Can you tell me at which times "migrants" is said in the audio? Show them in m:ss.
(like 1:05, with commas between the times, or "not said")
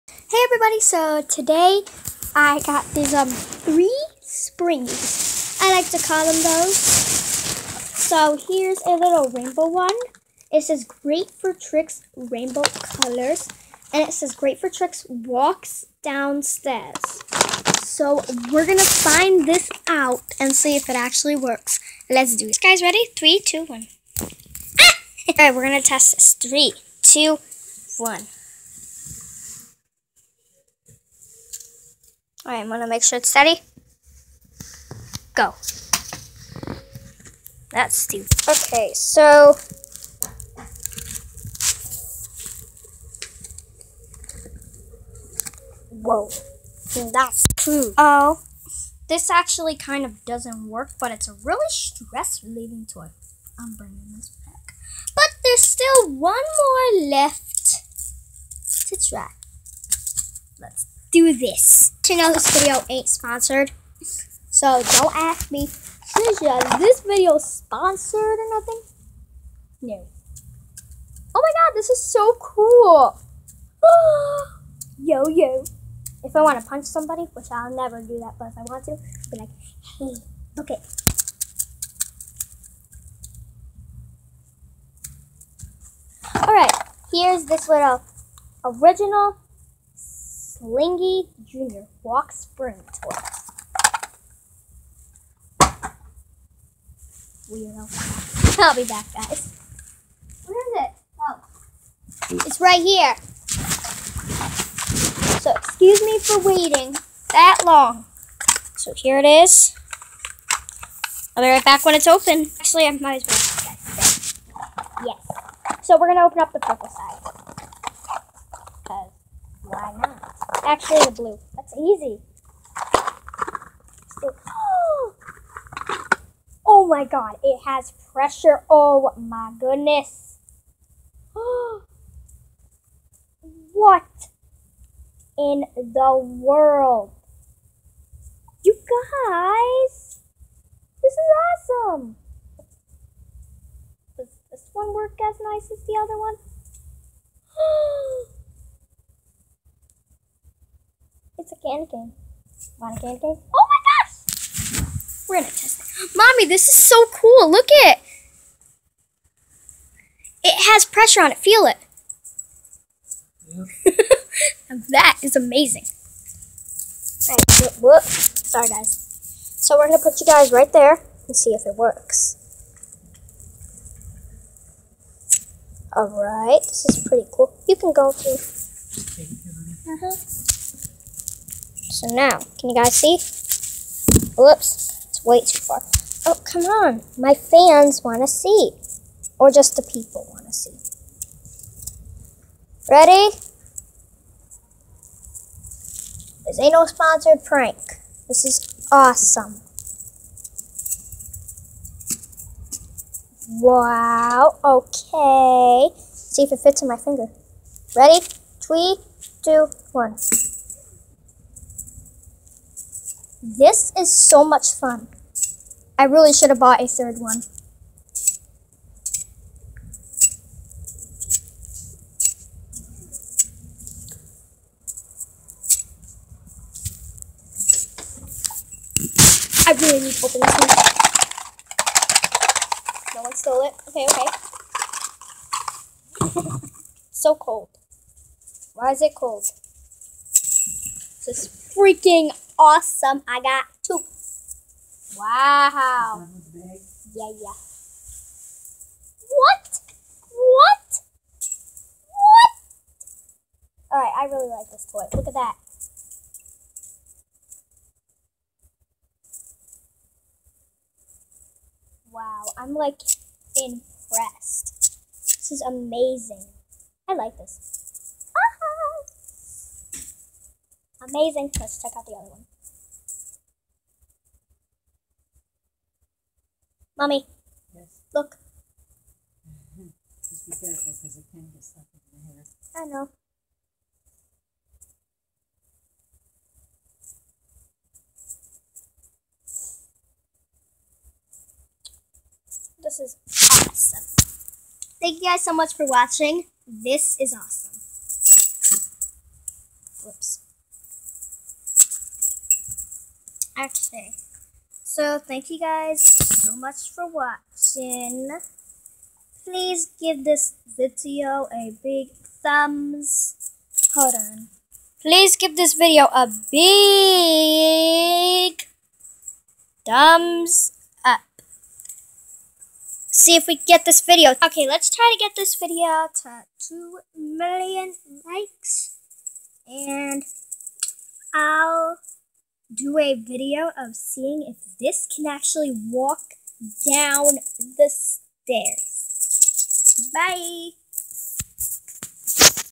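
not said.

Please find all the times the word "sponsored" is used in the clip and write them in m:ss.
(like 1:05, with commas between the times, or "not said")
1:03, 1:07, 3:16.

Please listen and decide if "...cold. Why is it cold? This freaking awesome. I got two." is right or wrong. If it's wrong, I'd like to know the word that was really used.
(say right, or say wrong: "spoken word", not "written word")
right.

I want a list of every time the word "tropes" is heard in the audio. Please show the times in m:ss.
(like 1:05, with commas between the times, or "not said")
not said.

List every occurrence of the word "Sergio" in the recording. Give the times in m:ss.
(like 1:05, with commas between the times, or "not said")
not said.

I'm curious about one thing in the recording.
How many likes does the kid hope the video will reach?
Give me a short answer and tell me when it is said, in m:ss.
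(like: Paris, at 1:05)
2 million, at 5:26.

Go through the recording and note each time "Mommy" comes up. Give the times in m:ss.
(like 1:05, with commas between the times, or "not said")
2:36, 4:37.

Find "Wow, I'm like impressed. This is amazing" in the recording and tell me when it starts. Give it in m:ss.
4:22.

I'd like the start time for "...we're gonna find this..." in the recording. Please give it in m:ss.
0:18.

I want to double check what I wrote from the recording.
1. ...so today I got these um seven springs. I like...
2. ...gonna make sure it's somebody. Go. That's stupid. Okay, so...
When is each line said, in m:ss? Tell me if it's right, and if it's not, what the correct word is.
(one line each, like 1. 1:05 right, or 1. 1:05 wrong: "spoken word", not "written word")
1. 0:00 wrong: "three", not "seven"
2. 0:32 wrong: "steady", not "somebody".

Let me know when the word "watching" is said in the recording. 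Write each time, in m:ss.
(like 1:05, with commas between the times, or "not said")
4:55, 5:07.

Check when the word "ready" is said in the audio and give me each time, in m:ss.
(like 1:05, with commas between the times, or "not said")
0:22, 3:12, 3:27.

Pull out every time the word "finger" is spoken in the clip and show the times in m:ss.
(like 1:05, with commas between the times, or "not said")
3:26.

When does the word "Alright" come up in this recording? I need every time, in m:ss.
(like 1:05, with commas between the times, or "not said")
0:25, 1:26, 2:55.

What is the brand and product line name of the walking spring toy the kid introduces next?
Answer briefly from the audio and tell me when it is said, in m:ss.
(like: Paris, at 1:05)
Slinky Jr., at 1:30.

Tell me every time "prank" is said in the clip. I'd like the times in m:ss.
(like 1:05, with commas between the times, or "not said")
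3:17.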